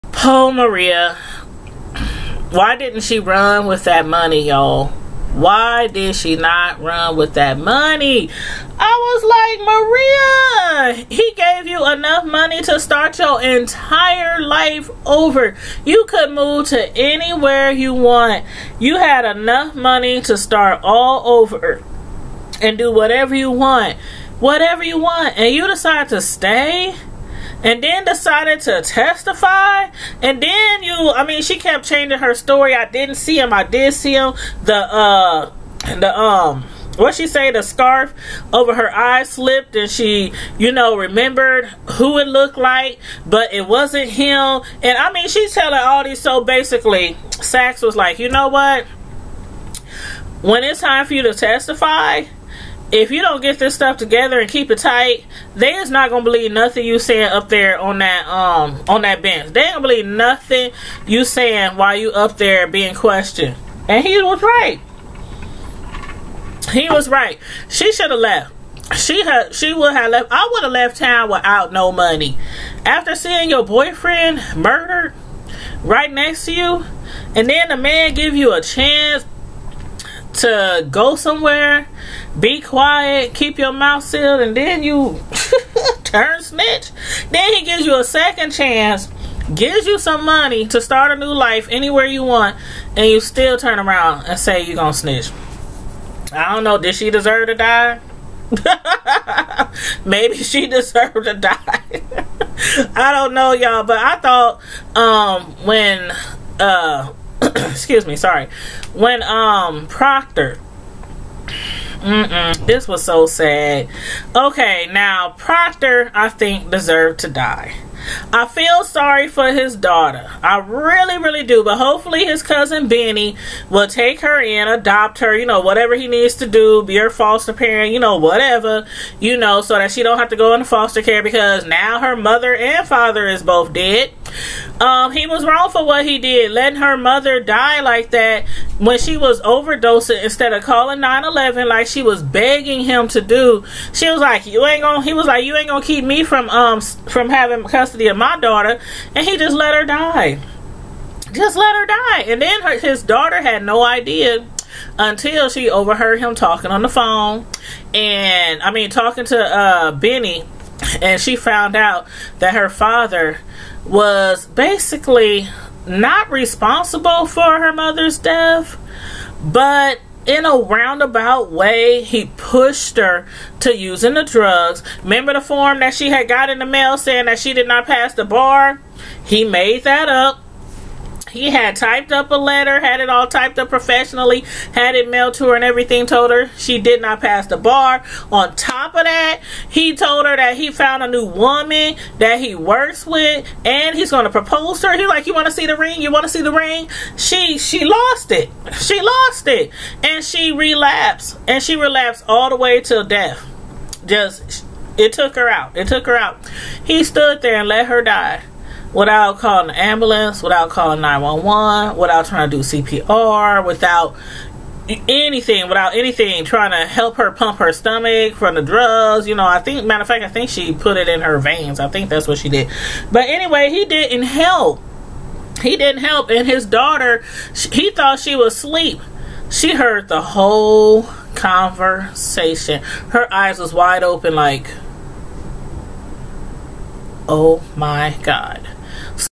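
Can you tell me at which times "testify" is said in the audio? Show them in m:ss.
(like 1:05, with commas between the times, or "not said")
0:28, 0:51.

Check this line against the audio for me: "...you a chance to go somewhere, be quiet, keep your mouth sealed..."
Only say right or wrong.
right.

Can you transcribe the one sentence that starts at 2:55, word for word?
Remember the form that she had got in the mail saying that she did not pass the bar?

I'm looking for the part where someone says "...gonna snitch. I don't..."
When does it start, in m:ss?
1:34.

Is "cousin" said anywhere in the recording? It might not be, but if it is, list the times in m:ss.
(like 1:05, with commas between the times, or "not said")
2:02.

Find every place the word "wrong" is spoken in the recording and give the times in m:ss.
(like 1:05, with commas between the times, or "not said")
2:15.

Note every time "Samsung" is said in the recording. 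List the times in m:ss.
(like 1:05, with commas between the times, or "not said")
not said.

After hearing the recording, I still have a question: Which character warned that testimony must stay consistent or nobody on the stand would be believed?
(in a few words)
Saxe.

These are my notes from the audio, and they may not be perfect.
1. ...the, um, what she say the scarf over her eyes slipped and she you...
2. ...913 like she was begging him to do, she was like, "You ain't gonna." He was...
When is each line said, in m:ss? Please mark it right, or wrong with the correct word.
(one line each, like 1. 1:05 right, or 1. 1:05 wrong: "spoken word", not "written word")
1. 0:35 right
2. 2:20 wrong: "911", not "913".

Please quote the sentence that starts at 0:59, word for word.
They don't believe nothing you saying while you up there being questioned.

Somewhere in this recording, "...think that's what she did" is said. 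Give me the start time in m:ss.
3:41.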